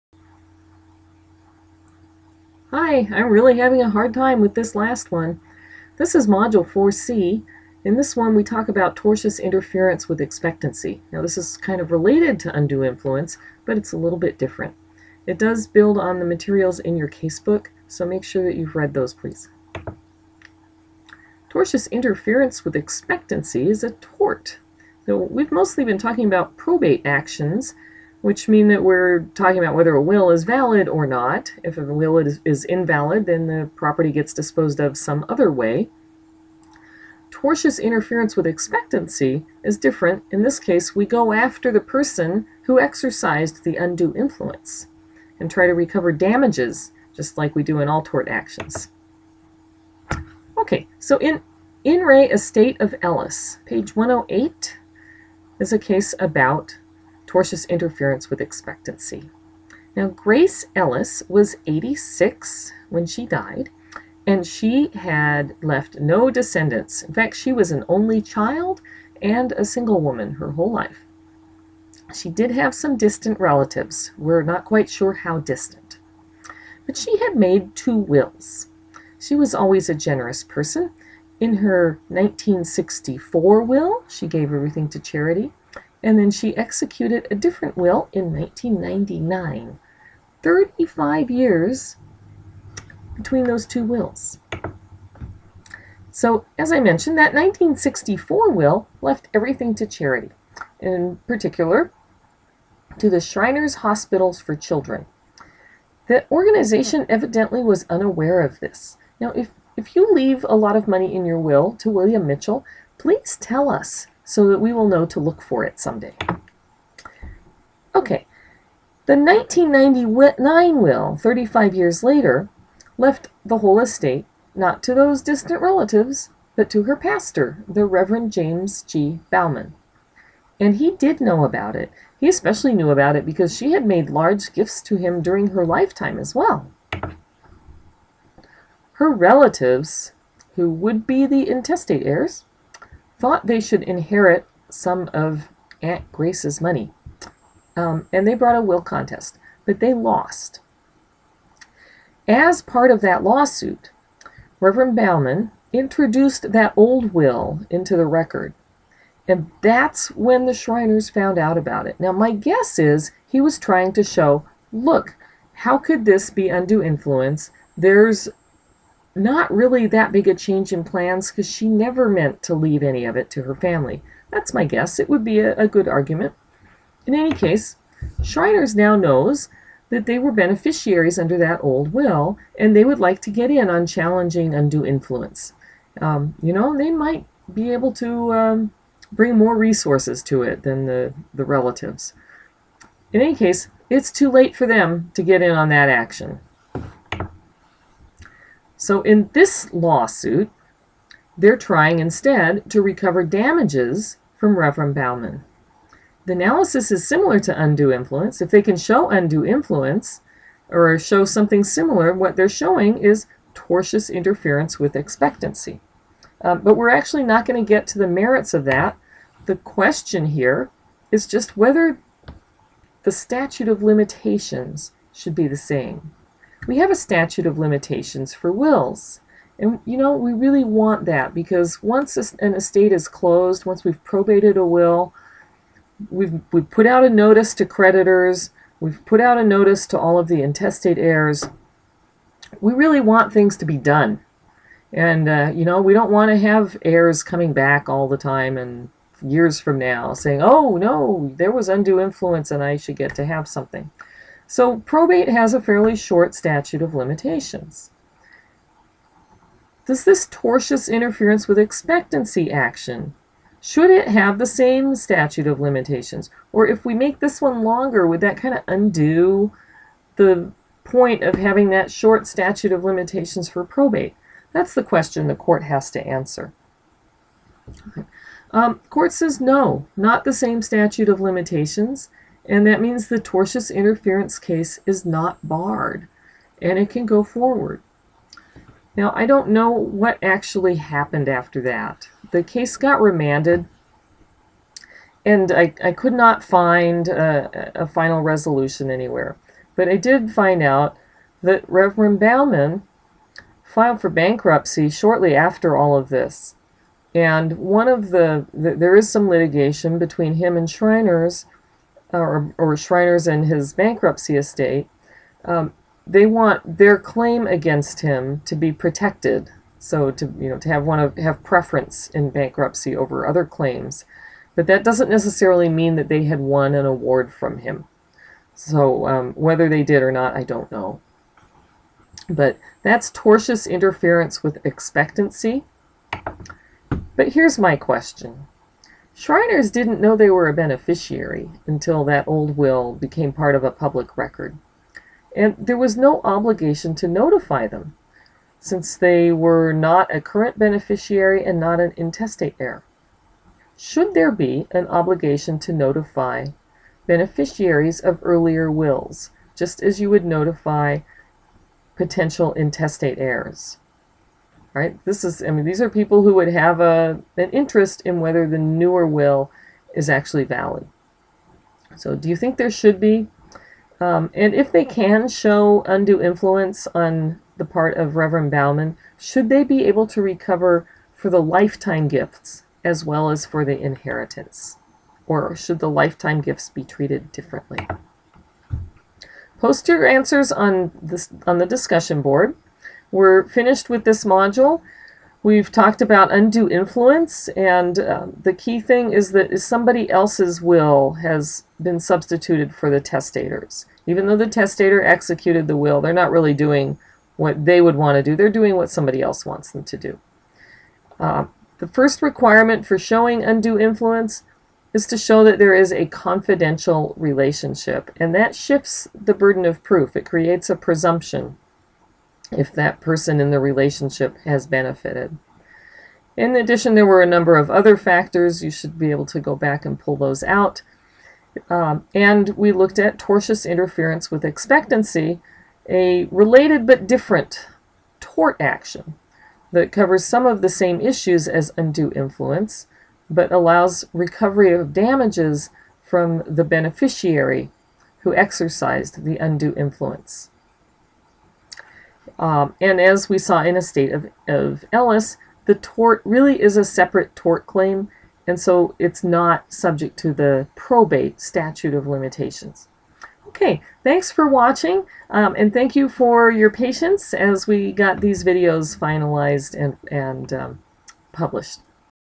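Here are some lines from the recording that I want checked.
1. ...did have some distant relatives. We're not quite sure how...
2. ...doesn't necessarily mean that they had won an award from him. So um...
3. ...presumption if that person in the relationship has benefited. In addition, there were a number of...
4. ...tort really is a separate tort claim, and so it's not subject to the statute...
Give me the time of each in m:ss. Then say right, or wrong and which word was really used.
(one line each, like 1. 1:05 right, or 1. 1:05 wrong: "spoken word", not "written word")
1. 1:12 right
2. 5:24 right
3. 7:00 right
4. 7:35 wrong: "probate", not "statute".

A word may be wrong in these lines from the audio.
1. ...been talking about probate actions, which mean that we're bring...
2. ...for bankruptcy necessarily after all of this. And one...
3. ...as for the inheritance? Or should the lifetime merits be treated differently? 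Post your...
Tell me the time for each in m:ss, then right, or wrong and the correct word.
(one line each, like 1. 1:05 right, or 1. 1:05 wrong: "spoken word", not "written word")
1. 0:25 wrong: "talking", not "bring"
2. 5:04 wrong: "shortly", not "necessarily"
3. 6:23 wrong: "gifts", not "merits".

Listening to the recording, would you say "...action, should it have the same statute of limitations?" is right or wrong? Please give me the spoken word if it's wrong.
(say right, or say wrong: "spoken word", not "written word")
right.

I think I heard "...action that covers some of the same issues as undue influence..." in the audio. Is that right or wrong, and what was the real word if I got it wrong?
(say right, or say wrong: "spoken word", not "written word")
right.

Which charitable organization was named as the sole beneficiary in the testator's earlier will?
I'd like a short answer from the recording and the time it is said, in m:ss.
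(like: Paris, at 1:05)
Shriners Hospitals for Children, at 1:43.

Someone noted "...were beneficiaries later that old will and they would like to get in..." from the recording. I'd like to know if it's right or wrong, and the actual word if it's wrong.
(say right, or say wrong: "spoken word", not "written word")
wrong: "under", not "later".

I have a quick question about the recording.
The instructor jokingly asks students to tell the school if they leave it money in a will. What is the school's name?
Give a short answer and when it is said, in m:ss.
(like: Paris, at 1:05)
William Mitchell, at 1:51.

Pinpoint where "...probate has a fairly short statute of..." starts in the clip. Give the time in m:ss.
4:14.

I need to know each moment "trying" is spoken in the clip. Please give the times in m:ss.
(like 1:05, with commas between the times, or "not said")
2:43, 3:21.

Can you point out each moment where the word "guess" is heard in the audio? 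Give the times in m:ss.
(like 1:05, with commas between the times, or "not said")
2:42, 2:54.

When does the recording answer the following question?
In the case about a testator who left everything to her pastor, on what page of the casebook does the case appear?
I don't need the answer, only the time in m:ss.
0:53.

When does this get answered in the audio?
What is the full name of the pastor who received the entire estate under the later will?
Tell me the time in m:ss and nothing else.
2:08.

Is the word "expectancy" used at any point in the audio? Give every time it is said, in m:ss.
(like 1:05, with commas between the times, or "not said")
0:10, 0:22, 0:38, 0:58, 3:34, 4:21, 5:34, 7:14.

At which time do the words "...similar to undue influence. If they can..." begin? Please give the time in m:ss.
3:27.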